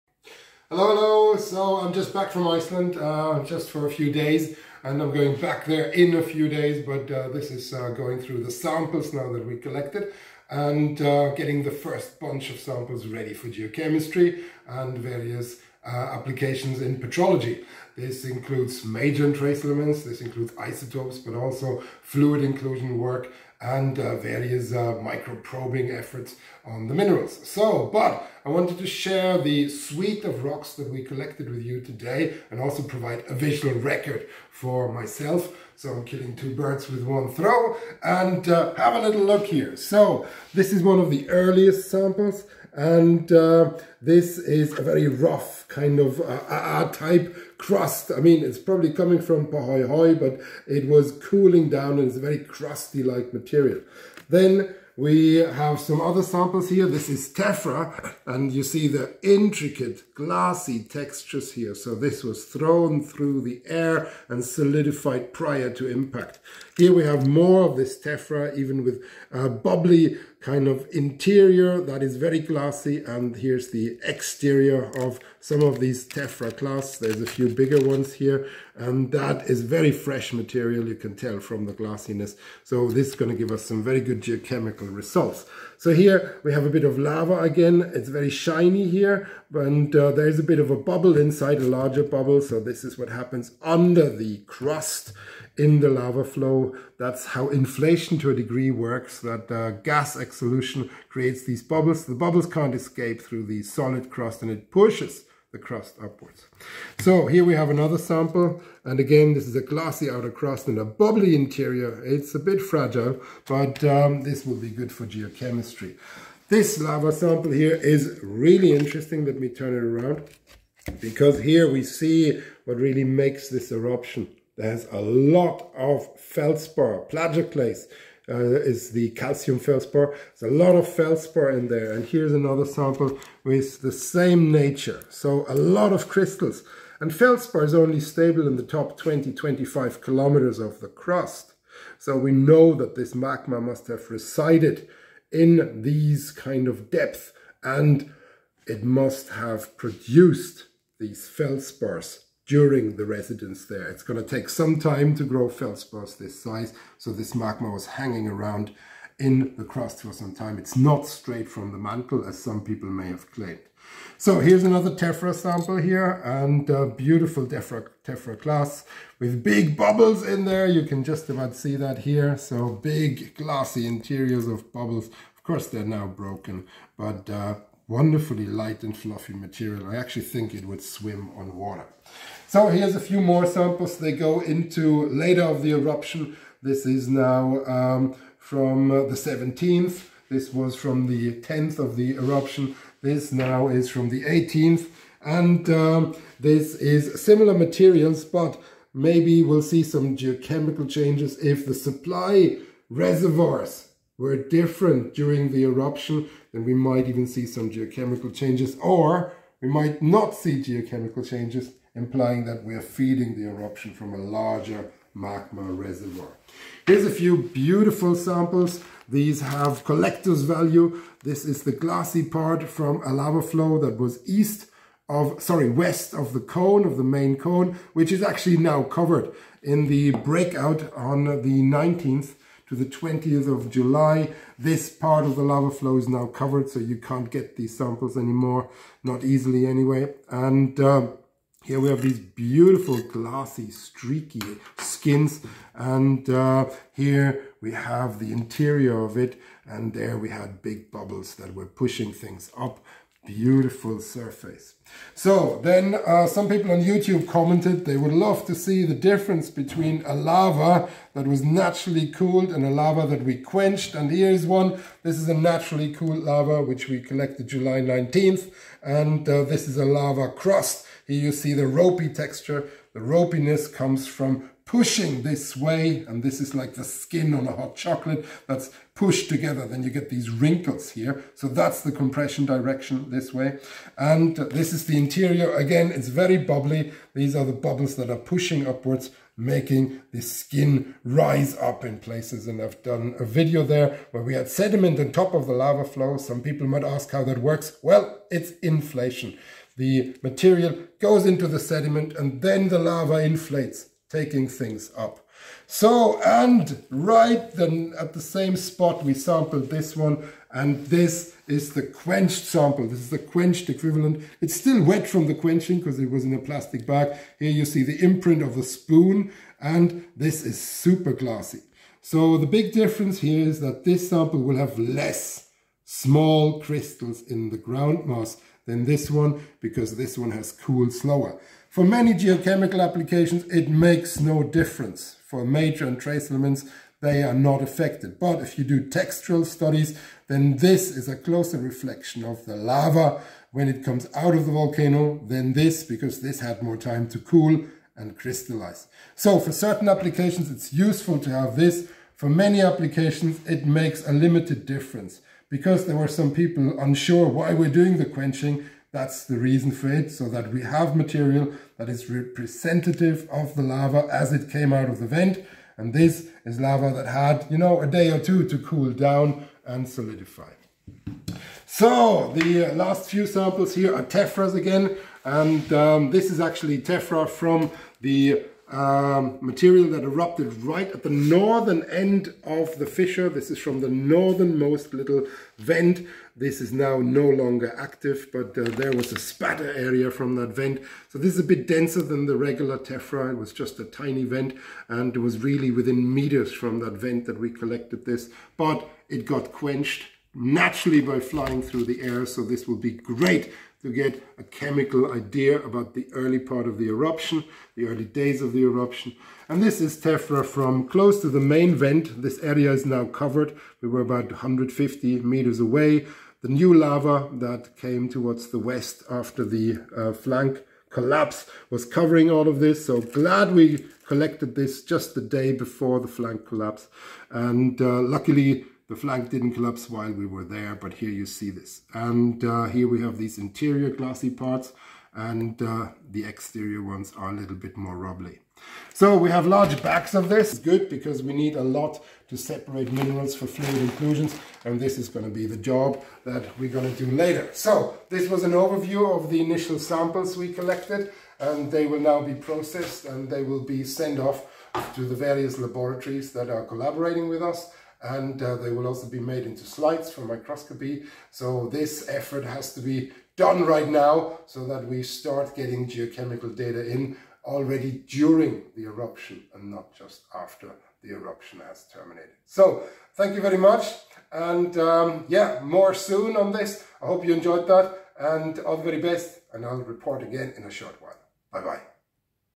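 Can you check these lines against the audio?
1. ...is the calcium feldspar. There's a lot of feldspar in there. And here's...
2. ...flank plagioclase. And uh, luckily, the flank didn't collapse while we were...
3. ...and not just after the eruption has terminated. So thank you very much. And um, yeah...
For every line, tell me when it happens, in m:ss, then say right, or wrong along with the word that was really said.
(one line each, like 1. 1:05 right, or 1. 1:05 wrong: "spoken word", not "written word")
1. 2:08 right
2. 7:06 wrong: "collapse", not "plagioclase"
3. 7:49 right.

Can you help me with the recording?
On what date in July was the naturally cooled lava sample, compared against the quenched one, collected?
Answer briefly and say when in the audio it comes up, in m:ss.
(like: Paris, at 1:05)
July 19th, at 4:27.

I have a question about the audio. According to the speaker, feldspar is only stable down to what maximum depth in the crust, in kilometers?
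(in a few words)
25.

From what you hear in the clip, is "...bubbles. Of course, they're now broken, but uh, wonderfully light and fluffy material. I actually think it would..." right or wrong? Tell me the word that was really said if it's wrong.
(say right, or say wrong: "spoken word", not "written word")
right.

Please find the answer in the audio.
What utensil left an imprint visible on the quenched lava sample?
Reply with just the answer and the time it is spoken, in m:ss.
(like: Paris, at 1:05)
spoon, at 5:18.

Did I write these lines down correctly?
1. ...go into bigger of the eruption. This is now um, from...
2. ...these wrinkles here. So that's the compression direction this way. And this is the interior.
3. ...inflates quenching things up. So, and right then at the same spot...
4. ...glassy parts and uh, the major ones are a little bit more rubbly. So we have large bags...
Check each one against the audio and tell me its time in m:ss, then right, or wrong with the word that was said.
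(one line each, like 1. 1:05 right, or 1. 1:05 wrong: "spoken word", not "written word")
1. 3:04 wrong: "later", not "bigger"
2. 4:40 right
3. 5:03 wrong: "taking", not "quenching"
4. 7:13 wrong: "exterior", not "major".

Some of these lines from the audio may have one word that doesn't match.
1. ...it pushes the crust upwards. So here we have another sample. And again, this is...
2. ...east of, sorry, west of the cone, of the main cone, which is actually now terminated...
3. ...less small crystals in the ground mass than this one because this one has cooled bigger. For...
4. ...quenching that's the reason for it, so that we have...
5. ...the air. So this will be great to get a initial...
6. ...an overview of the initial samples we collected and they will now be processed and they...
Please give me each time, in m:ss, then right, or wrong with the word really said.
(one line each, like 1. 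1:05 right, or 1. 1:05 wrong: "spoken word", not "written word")
1. 1:44 right
2. 3:44 wrong: "covered", not "terminated"
3. 5:24 wrong: "slower", not "bigger"
4. 5:58 right
5. 6:41 wrong: "chemical", not "initial"
6. 7:28 right.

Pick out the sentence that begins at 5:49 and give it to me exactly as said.
So for certain applications, it's useful to have this.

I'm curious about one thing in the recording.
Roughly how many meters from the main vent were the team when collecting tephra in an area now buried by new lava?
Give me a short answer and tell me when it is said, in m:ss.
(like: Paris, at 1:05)
150, at 6:54.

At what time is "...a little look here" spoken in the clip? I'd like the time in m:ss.
0:38.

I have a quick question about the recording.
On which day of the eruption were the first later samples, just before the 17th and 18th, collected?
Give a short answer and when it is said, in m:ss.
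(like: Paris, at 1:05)
10th, at 3:11.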